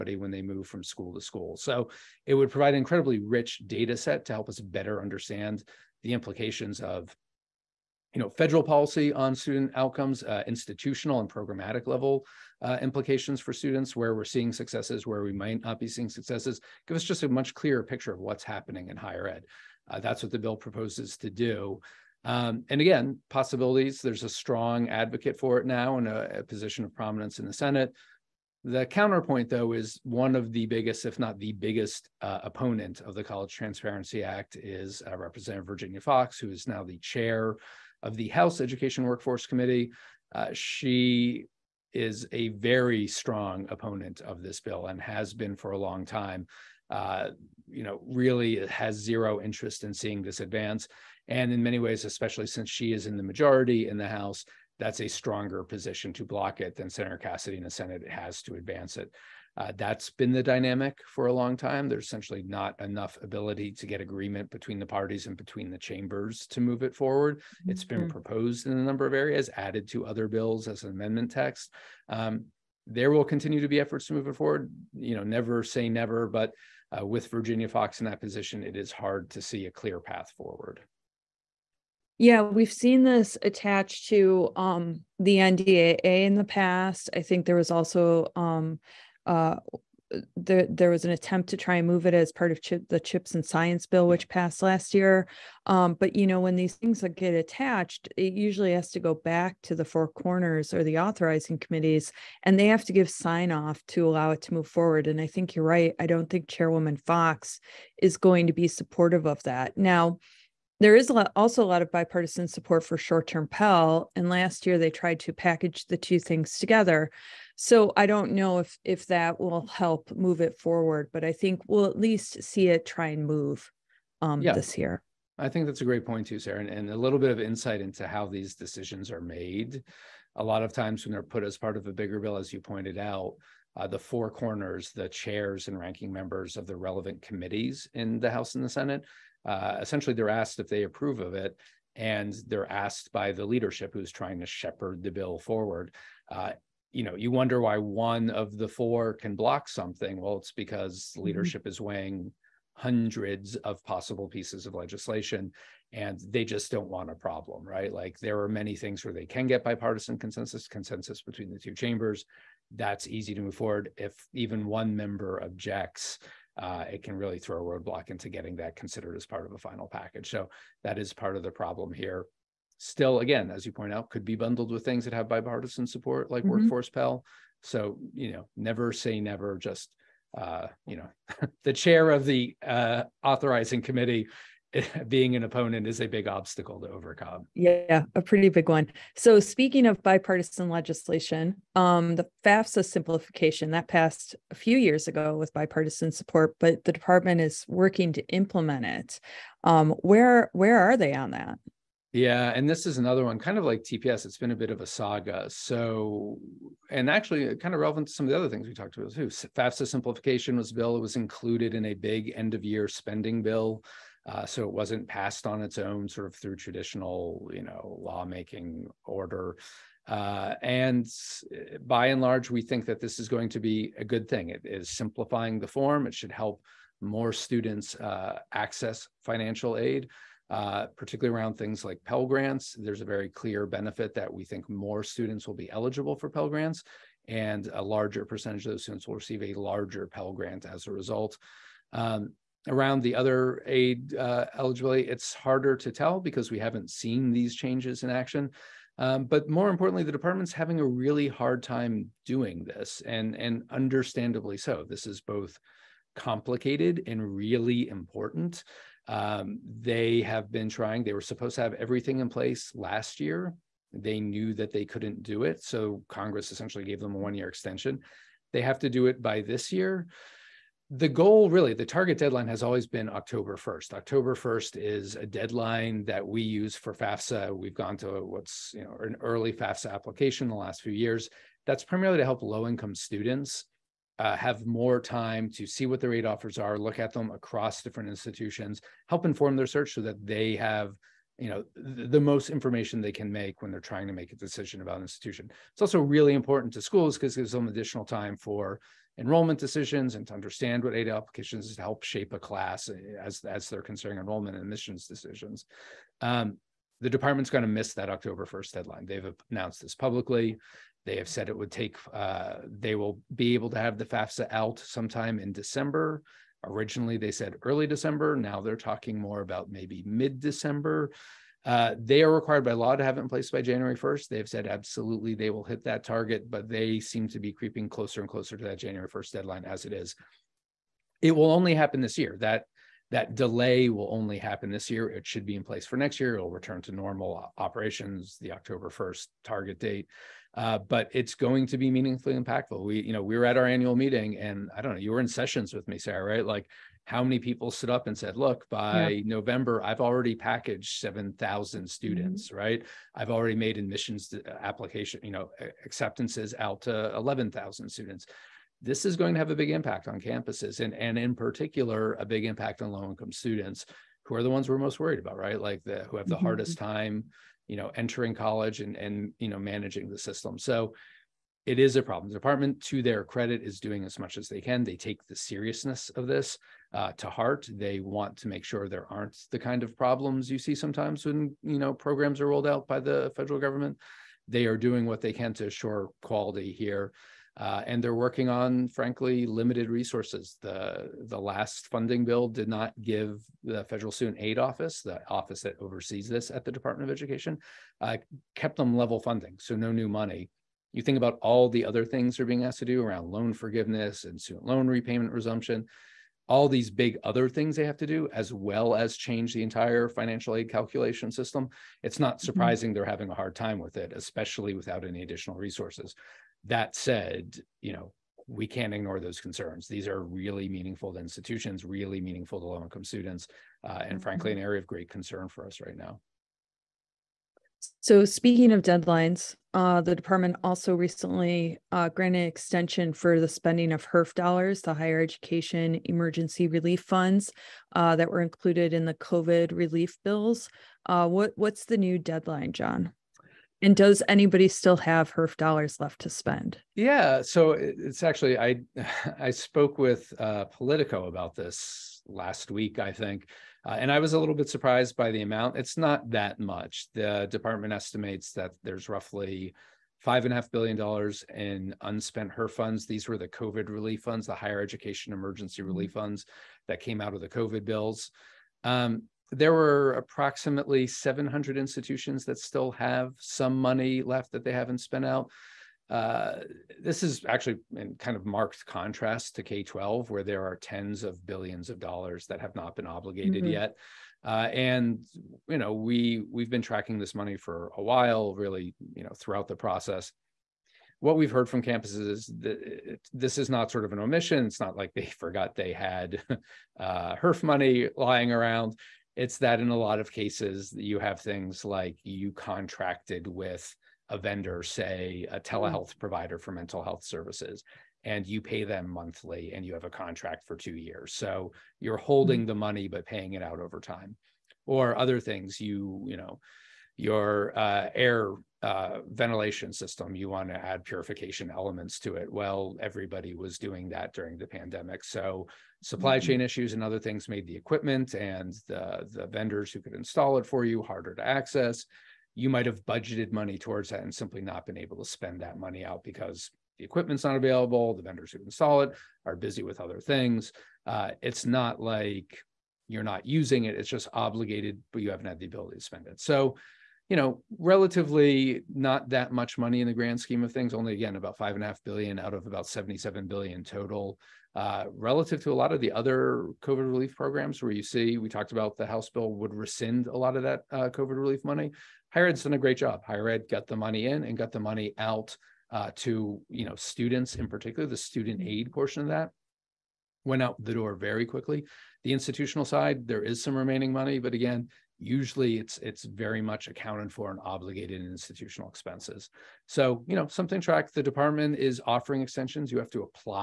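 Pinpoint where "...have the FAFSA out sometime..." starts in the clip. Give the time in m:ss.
5:13.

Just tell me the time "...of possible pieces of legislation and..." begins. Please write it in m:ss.
2:33.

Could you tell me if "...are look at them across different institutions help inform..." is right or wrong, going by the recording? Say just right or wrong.
right.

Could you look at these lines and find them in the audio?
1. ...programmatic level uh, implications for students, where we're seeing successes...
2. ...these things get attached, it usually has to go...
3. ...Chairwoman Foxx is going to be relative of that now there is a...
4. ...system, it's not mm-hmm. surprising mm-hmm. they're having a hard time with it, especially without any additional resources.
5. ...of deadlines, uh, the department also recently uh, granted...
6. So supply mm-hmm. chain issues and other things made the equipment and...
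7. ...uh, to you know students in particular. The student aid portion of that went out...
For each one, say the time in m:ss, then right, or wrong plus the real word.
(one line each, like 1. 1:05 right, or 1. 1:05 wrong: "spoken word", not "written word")
1. 0:11 right
2. 1:36 right
3. 1:46 wrong: "supportive", not "relative"
4. 6:51 right
5. 7:08 right
6. 8:45 right
7. 9:25 right.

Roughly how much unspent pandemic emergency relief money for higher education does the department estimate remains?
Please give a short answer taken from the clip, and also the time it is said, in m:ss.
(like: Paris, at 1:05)
5.5 billion dollars, at 7:40.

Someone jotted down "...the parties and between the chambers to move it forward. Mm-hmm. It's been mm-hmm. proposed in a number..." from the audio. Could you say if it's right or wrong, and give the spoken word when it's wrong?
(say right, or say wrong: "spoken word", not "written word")
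right.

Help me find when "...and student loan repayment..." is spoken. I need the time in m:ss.
6:44.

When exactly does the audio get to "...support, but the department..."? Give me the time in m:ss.
3:16.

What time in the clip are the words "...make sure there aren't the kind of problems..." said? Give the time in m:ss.
6:18.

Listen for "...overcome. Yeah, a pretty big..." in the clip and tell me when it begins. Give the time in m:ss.
3:06.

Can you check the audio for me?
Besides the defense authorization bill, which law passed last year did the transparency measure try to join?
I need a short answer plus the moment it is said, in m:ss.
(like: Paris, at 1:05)
Chips and Science Bill, at 1:32.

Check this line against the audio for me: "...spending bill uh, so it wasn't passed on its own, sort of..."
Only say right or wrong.
right.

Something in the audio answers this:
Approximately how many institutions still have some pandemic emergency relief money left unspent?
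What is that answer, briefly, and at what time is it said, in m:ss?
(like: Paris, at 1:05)
700, at 7:51.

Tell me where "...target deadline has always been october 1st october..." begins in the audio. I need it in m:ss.
4:31.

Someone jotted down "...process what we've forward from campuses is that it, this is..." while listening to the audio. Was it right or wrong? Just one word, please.
wrong.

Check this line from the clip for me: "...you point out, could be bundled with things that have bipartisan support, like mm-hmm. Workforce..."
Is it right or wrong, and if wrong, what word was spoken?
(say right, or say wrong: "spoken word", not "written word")
right.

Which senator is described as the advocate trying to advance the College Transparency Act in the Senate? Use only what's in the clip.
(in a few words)
Senator Cassidy.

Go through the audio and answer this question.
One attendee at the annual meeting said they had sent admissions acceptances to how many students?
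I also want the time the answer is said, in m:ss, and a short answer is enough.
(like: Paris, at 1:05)
11,000, at 5:57.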